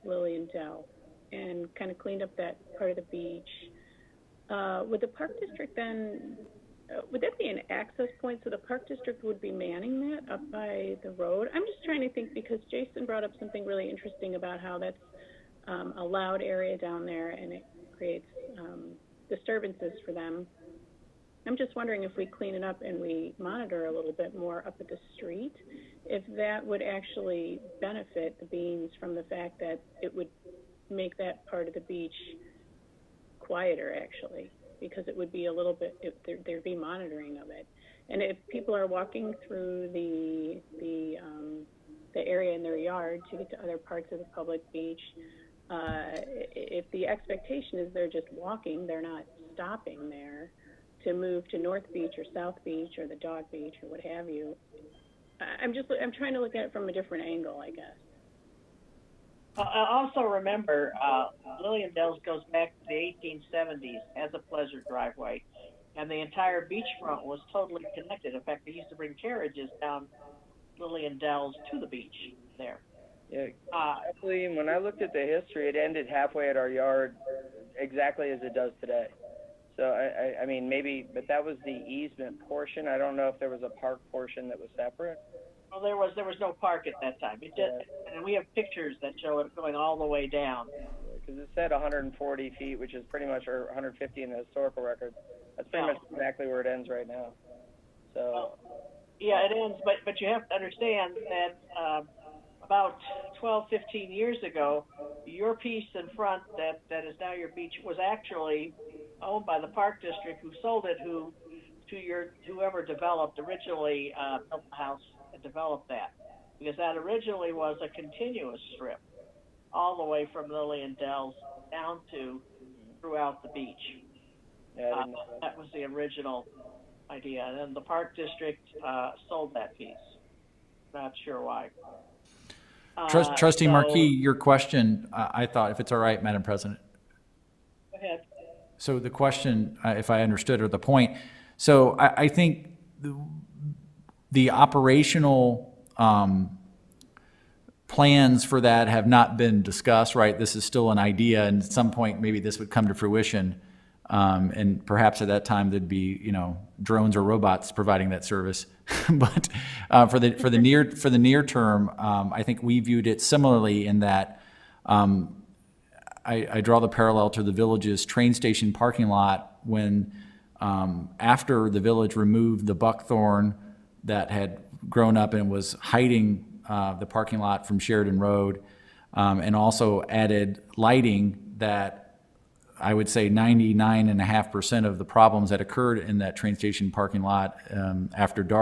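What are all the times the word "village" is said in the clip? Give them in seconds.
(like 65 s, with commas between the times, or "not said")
167 s, 171 s.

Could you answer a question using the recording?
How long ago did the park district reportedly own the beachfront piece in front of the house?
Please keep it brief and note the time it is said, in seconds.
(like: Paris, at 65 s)
12 to 15 years, at 103 s.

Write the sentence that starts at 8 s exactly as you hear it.
So the park district would be manning that up by the road?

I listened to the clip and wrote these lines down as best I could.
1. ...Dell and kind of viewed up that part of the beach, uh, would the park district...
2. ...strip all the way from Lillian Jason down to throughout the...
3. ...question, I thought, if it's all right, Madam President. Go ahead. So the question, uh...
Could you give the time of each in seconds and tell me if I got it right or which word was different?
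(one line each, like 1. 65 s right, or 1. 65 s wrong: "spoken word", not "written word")
1. 0 s wrong: "cleaned", not "viewed"
2. 118 s wrong: "Dells", not "Jason"
3. 134 s right.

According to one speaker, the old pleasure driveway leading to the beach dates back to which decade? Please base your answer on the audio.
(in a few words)
1870s.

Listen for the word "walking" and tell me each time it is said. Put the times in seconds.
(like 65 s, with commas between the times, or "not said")
38 s, 48 s.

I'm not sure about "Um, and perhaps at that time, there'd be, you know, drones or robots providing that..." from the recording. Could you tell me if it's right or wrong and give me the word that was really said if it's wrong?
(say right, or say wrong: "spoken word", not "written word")
right.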